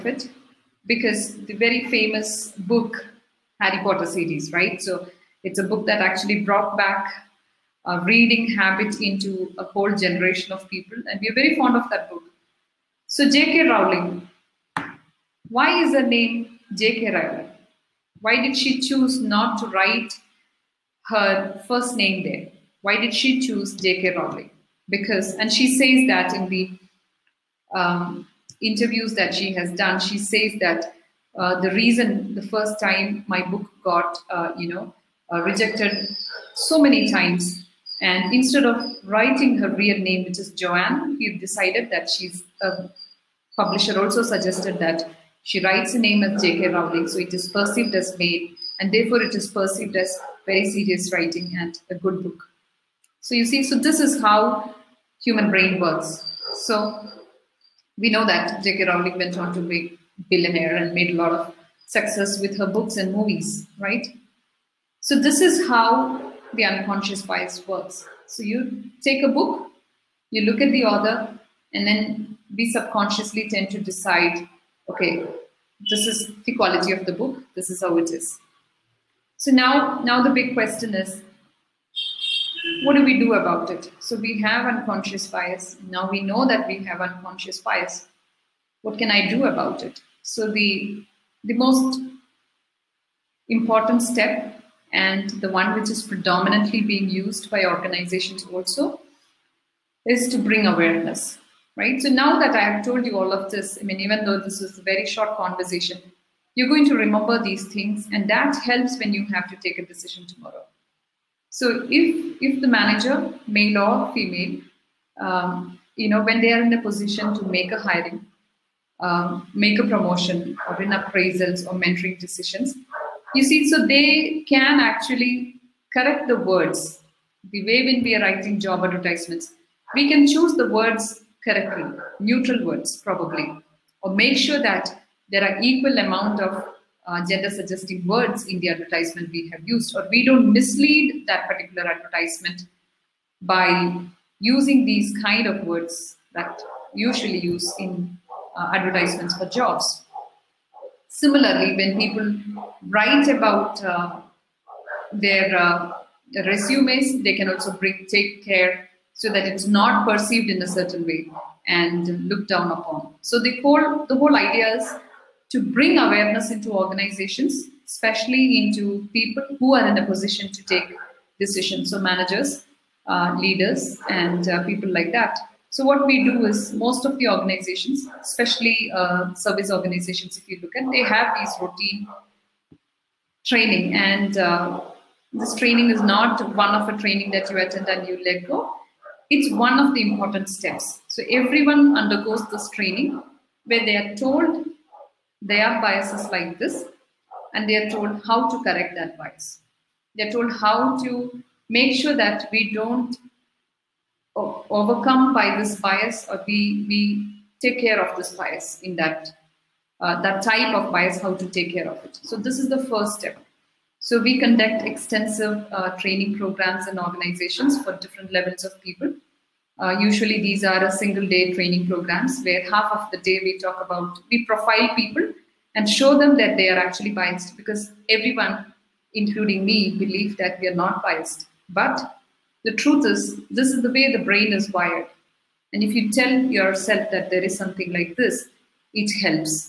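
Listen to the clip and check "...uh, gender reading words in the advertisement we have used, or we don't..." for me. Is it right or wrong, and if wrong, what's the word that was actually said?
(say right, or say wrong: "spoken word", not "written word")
wrong: "suggesting", not "reading".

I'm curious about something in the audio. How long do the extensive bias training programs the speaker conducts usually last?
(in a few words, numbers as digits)
a single day.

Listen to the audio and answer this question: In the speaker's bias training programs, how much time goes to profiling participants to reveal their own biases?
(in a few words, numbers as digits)
half of the day.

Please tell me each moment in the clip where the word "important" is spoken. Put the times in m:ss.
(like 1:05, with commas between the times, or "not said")
1:33, 3:10.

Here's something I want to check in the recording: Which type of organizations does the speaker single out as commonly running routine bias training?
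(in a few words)
service organizations.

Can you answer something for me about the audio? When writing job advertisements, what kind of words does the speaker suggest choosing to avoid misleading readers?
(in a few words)
neutral words.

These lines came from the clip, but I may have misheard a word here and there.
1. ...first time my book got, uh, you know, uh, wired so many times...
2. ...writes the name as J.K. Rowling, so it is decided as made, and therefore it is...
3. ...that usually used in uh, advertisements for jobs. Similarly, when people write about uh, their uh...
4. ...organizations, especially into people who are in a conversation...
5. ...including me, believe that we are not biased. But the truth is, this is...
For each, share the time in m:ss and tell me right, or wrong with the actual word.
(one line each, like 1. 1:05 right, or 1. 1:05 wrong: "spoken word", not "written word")
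1. 0:32 wrong: "rejected", not "wired"
2. 0:45 wrong: "perceived", not "decided"
3. 2:26 right
4. 2:46 wrong: "position", not "conversation"
5. 3:49 right.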